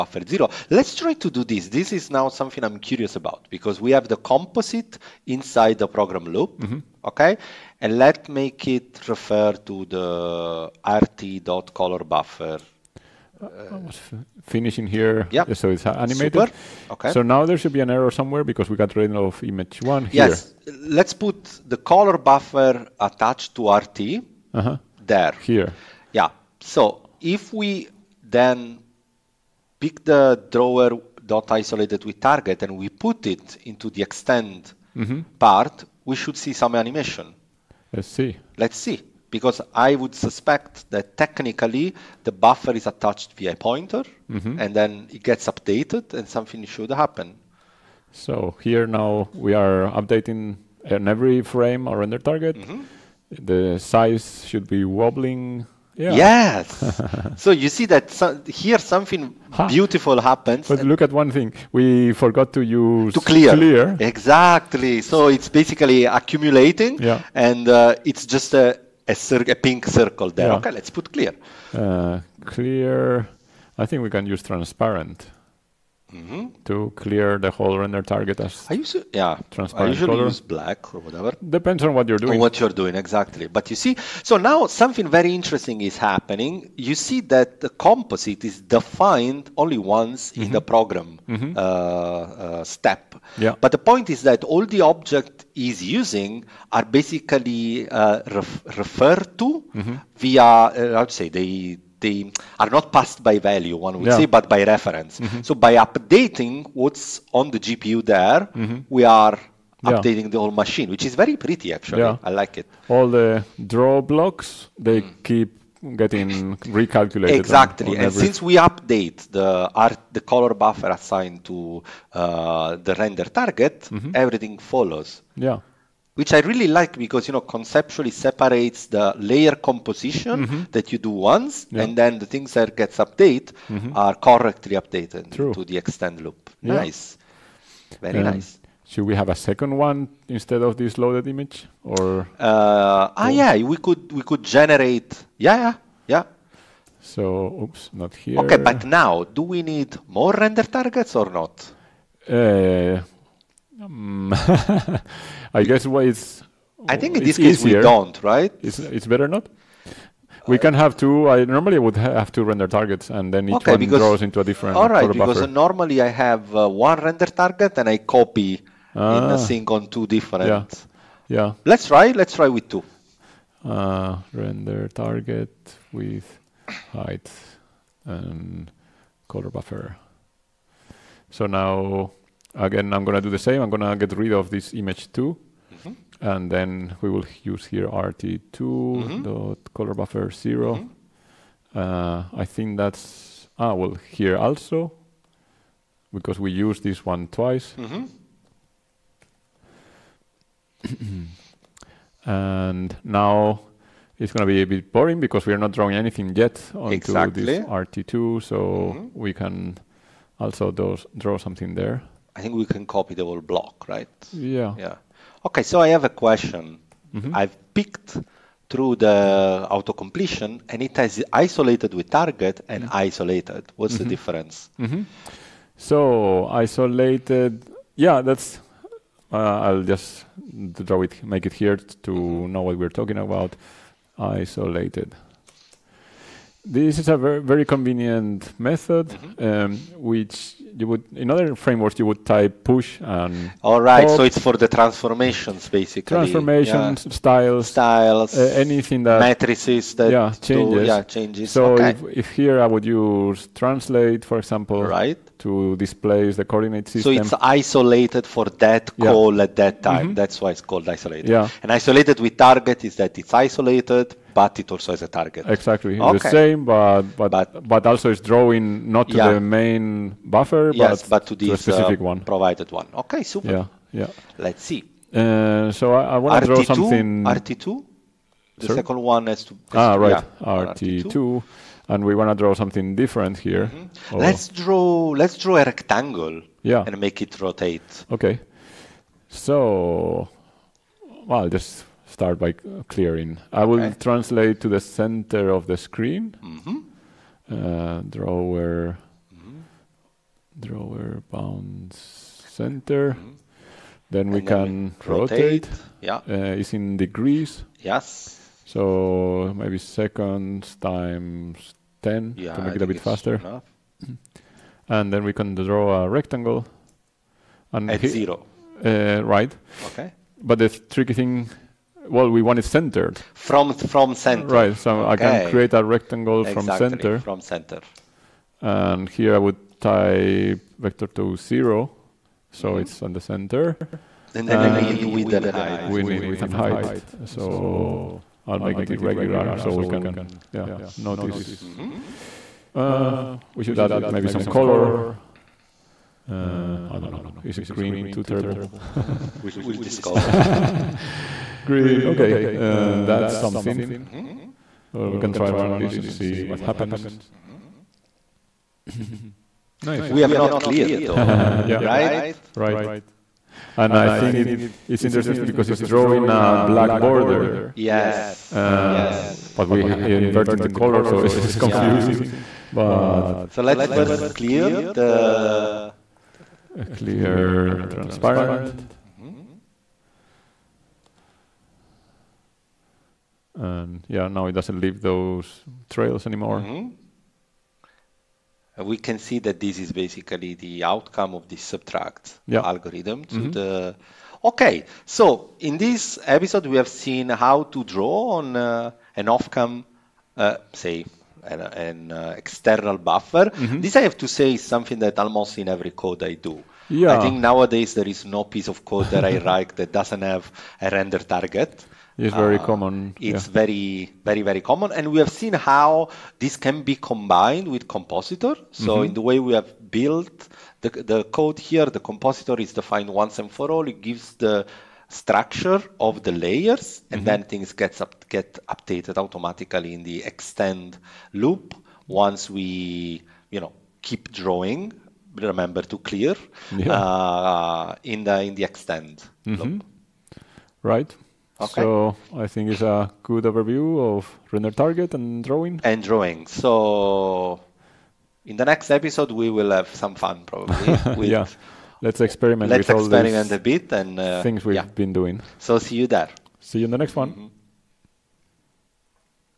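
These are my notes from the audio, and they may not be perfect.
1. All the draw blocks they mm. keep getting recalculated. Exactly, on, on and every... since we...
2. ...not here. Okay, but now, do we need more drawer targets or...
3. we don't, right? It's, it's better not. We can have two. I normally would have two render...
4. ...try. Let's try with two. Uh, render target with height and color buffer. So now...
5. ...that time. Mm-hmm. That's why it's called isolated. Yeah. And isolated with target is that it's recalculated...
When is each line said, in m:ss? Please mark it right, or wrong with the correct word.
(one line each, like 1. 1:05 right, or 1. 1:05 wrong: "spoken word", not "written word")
1. 1:52 right
2. 2:27 wrong: "render", not "drawer"
3. 2:37 right
4. 2:51 right
5. 4:19 wrong: "isolated", not "recalculated".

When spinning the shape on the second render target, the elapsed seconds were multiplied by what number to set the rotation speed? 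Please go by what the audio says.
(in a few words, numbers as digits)
10.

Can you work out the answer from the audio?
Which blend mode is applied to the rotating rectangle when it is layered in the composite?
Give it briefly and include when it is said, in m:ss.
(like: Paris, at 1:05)
subtract, at 6:31.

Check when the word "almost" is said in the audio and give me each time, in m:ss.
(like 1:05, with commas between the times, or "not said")
6:45.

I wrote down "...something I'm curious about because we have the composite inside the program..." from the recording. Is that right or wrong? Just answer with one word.
right.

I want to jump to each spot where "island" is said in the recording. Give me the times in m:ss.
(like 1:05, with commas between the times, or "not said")
not said.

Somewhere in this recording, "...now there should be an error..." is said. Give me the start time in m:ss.
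0:17.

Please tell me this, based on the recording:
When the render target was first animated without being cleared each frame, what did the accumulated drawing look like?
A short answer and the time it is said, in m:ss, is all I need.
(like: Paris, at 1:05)
pink circle, at 1:09.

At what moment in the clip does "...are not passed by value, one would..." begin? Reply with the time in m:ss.
1:42.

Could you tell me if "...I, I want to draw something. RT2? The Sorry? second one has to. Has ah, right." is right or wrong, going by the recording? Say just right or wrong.
right.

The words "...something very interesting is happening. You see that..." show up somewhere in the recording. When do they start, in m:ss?
1:24.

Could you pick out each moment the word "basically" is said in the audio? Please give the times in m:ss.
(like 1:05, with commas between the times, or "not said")
1:05, 1:36, 4:05, 6:29.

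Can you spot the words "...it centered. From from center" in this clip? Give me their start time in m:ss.
5:22.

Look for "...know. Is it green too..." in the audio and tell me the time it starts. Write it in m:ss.
5:47.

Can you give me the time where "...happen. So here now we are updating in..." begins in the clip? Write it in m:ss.
0:46.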